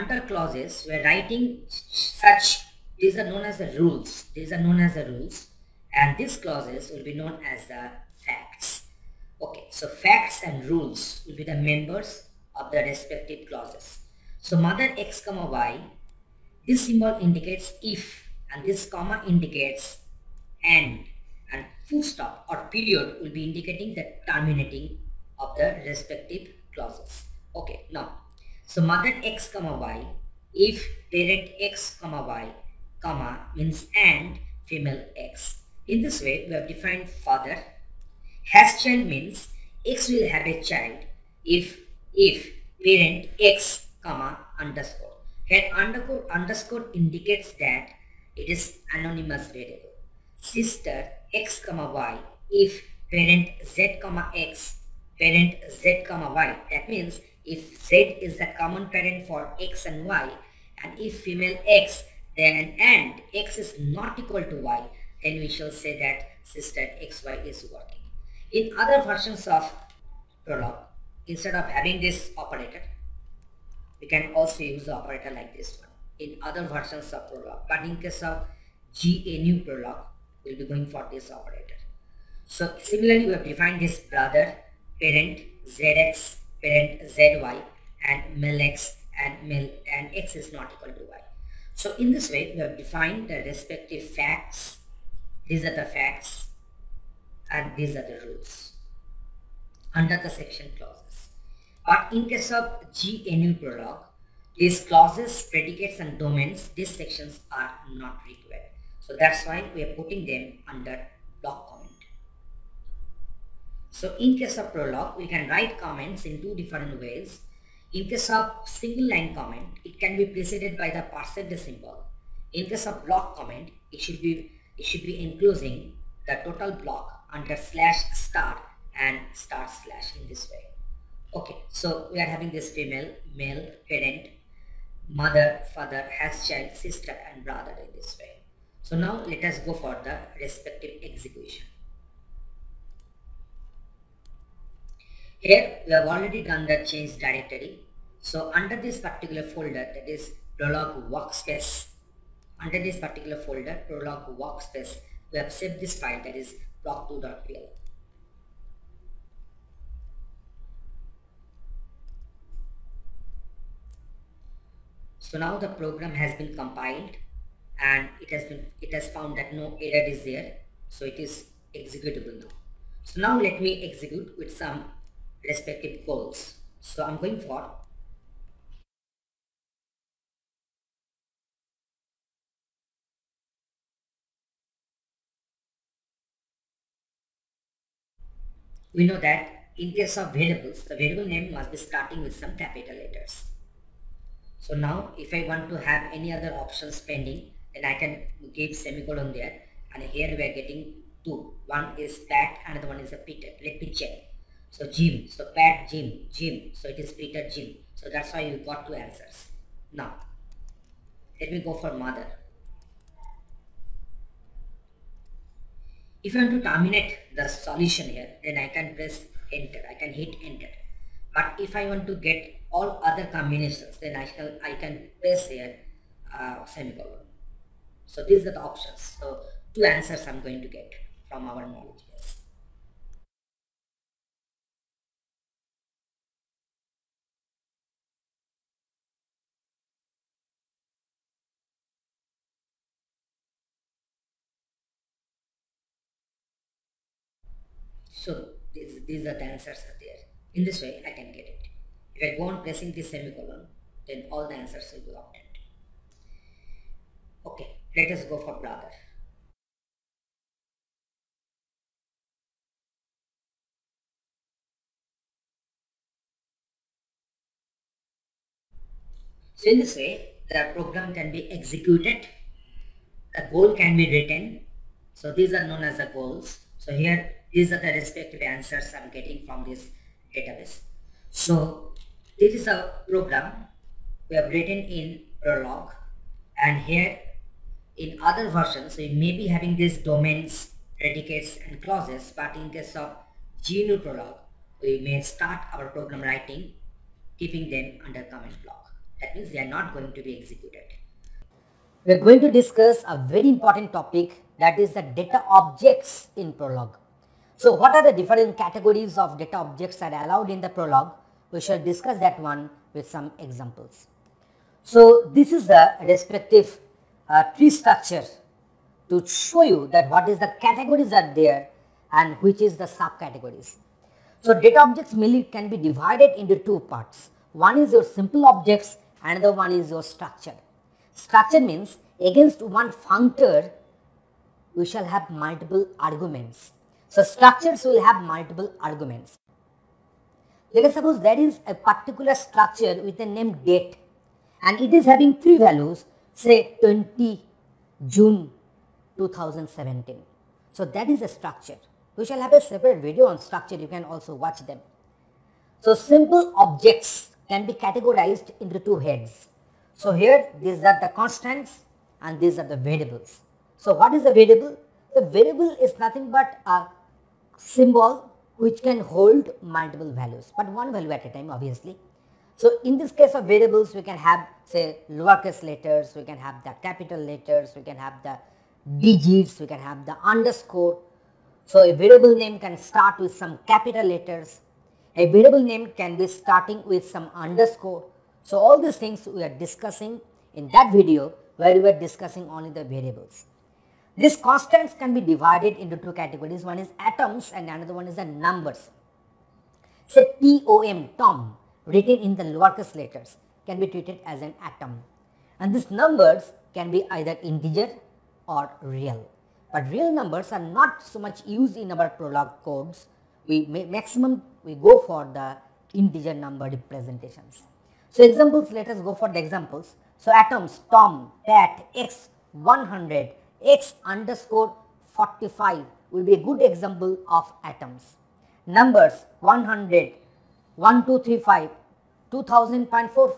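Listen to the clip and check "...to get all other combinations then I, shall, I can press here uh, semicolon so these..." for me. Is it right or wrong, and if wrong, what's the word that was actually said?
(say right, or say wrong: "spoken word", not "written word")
right.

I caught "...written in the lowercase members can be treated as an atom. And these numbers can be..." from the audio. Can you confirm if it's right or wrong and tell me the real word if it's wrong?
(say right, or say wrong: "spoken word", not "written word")
wrong: "letters", not "members".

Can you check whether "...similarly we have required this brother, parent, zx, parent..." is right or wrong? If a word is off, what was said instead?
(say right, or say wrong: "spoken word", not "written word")
wrong: "defined", not "required".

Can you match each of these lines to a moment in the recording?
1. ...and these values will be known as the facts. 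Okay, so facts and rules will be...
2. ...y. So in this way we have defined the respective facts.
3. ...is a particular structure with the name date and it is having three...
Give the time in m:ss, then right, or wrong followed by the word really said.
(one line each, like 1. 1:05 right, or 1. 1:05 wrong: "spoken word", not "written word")
1. 0:05 wrong: "clauses", not "values"
2. 1:31 right
3. 5:41 right.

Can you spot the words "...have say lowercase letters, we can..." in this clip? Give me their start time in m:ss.
6:14.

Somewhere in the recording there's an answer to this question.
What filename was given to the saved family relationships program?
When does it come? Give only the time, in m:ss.
2:36.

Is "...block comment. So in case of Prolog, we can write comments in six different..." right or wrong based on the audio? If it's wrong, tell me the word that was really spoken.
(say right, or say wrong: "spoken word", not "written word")
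wrong: "two", not "six".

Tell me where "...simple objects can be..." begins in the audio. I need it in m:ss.
5:55.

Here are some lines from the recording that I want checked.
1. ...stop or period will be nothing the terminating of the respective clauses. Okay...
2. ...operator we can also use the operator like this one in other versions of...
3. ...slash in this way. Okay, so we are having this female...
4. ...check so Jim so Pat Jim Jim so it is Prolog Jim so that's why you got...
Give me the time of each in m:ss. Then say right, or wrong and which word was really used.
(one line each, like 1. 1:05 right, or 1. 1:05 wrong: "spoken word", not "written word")
1. 0:22 wrong: "indicating", not "nothing"
2. 1:12 right
3. 2:09 right
4. 3:23 wrong: "Peter", not "Prolog".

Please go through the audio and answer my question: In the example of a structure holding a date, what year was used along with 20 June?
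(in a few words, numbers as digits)
2017.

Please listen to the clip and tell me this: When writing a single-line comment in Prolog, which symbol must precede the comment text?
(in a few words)
percent symbol.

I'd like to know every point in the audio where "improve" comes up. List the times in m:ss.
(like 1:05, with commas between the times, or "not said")
not said.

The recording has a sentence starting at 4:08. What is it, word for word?
So these, these are the answers are there.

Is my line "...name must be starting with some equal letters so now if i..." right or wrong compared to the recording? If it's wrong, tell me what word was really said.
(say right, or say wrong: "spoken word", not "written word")
wrong: "capital", not "equal".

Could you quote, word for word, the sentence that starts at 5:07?
So what are the different categories of data objects that are allowed in the Prolog?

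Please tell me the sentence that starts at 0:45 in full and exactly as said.
Here underscore underscore indicates that it is anonymous variable.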